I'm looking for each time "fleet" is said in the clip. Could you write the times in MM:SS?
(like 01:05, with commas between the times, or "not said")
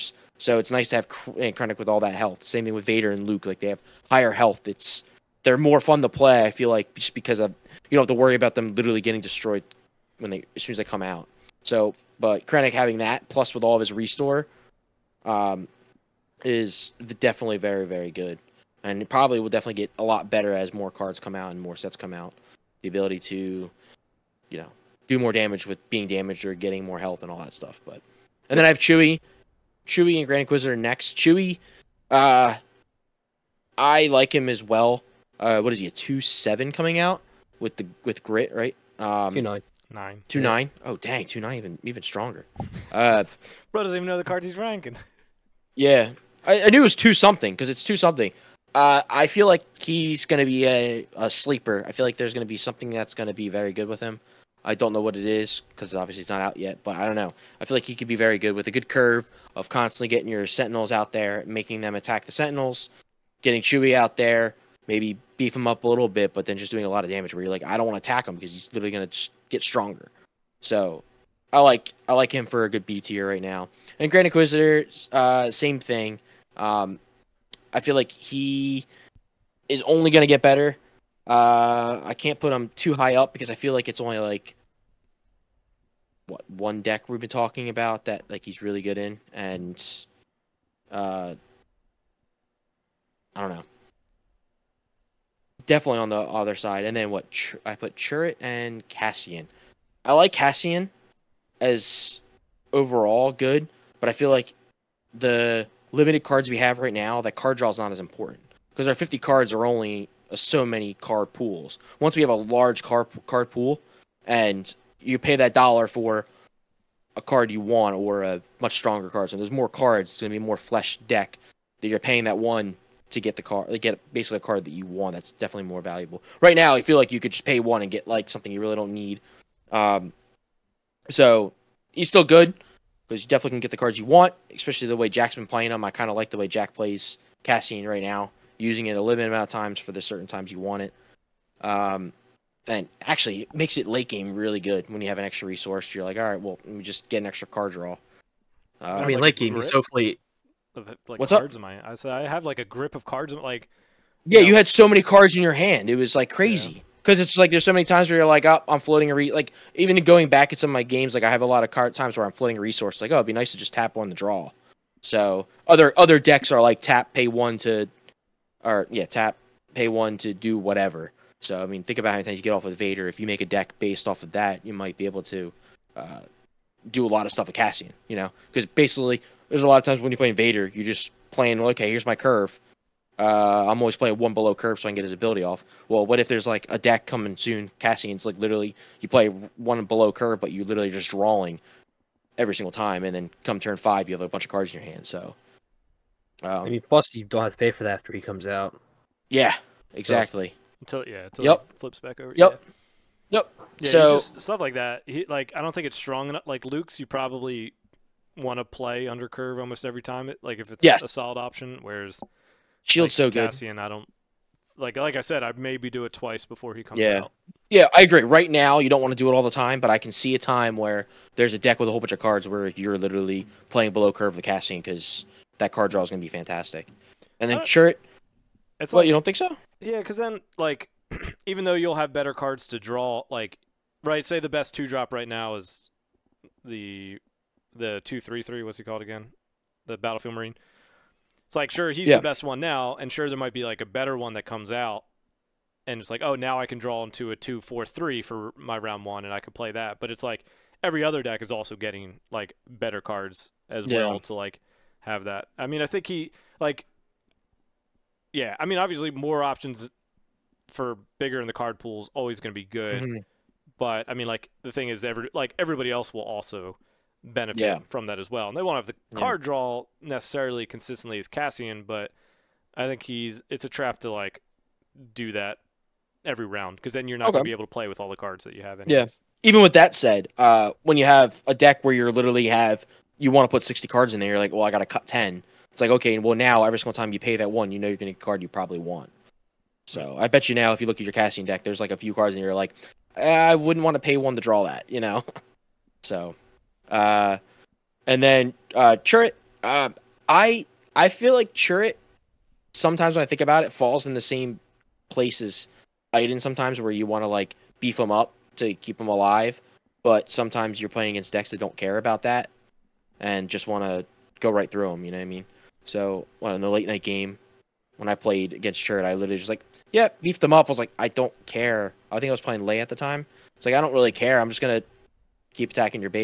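02:29.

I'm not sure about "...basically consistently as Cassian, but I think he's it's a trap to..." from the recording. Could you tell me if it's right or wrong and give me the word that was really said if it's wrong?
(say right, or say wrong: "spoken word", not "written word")
wrong: "necessarily", not "basically".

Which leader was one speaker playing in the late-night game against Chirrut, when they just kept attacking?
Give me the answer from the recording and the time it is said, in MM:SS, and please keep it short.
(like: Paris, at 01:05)
Leia, at 05:22.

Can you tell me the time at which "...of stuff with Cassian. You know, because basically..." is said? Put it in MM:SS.
02:57.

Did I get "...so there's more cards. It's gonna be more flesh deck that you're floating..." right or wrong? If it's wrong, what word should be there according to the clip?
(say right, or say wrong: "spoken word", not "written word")
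wrong: "paying", not "floating".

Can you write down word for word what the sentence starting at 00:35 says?
Uh, what is he a two seven coming out with the with grit right?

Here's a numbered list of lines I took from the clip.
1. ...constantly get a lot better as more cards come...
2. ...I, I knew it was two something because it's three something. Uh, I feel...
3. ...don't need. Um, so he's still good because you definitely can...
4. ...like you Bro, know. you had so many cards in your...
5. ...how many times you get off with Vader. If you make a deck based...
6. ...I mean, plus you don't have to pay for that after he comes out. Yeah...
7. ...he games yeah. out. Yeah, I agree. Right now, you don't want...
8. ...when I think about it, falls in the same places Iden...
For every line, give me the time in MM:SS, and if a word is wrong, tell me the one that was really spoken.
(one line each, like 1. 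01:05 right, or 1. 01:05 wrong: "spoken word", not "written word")
1. 00:19 wrong: "definitely", not "constantly"
2. 00:46 wrong: "two", not "three"
3. 02:08 right
4. 02:33 wrong: "Yeah", not "Bro"
5. 02:52 right
6. 03:16 right
7. 03:36 wrong: "comes", not "games"
8. 05:03 right.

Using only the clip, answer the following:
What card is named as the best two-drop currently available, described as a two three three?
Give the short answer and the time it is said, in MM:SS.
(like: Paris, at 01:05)
Battlefield Marine, at 03:59.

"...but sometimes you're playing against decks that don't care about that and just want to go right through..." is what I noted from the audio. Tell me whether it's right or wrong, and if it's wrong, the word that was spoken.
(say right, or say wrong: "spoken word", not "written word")
right.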